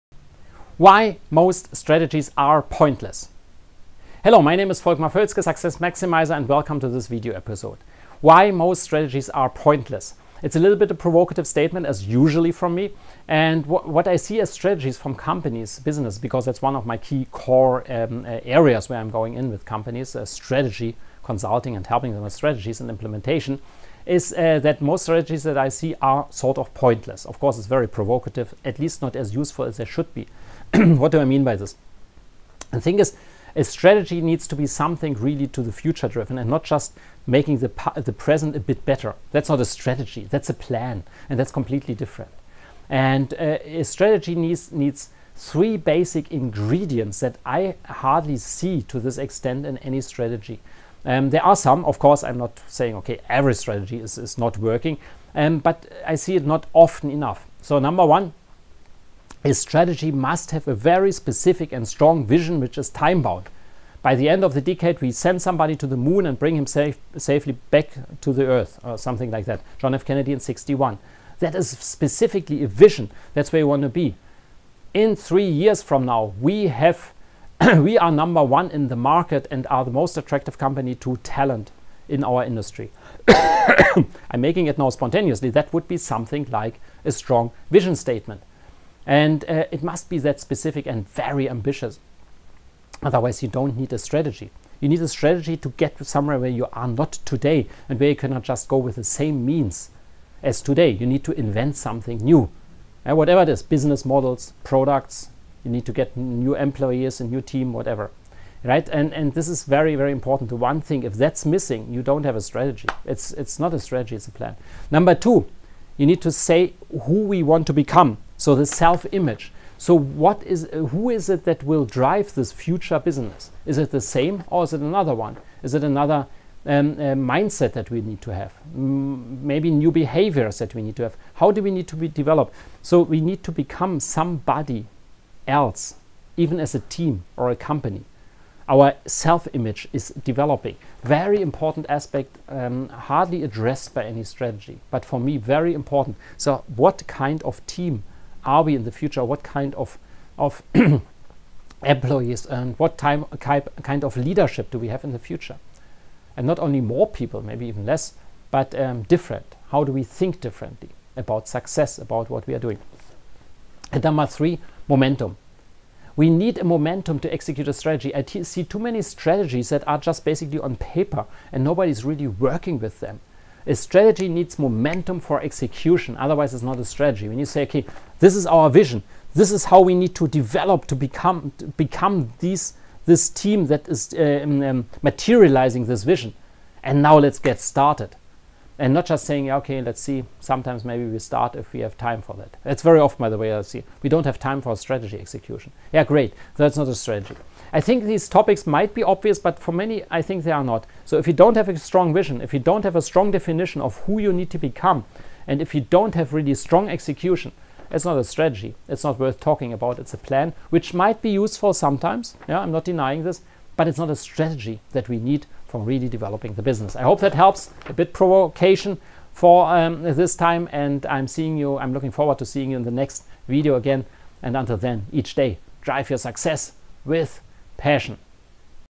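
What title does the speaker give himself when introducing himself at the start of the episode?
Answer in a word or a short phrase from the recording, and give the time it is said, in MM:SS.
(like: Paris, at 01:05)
Success Maximizer, at 00:05.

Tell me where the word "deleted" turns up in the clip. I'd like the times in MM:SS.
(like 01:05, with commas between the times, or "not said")
not said.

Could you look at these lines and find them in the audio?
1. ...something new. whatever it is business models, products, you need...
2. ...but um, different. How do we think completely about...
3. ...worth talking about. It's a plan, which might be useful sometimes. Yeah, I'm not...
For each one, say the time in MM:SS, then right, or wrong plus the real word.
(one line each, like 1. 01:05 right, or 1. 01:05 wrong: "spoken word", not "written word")
1. 01:41 right
2. 02:38 wrong: "differently", not "completely"
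3. 03:29 right.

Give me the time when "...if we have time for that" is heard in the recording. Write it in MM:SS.
03:11.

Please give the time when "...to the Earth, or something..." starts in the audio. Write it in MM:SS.
01:08.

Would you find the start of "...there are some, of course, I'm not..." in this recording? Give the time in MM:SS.
00:51.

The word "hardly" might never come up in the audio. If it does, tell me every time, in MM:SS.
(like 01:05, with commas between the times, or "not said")
00:47, 02:22.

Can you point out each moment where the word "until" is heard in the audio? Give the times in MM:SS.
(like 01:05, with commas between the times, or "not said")
03:44.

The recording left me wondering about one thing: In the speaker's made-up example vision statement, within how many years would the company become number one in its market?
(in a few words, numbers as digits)
3 years.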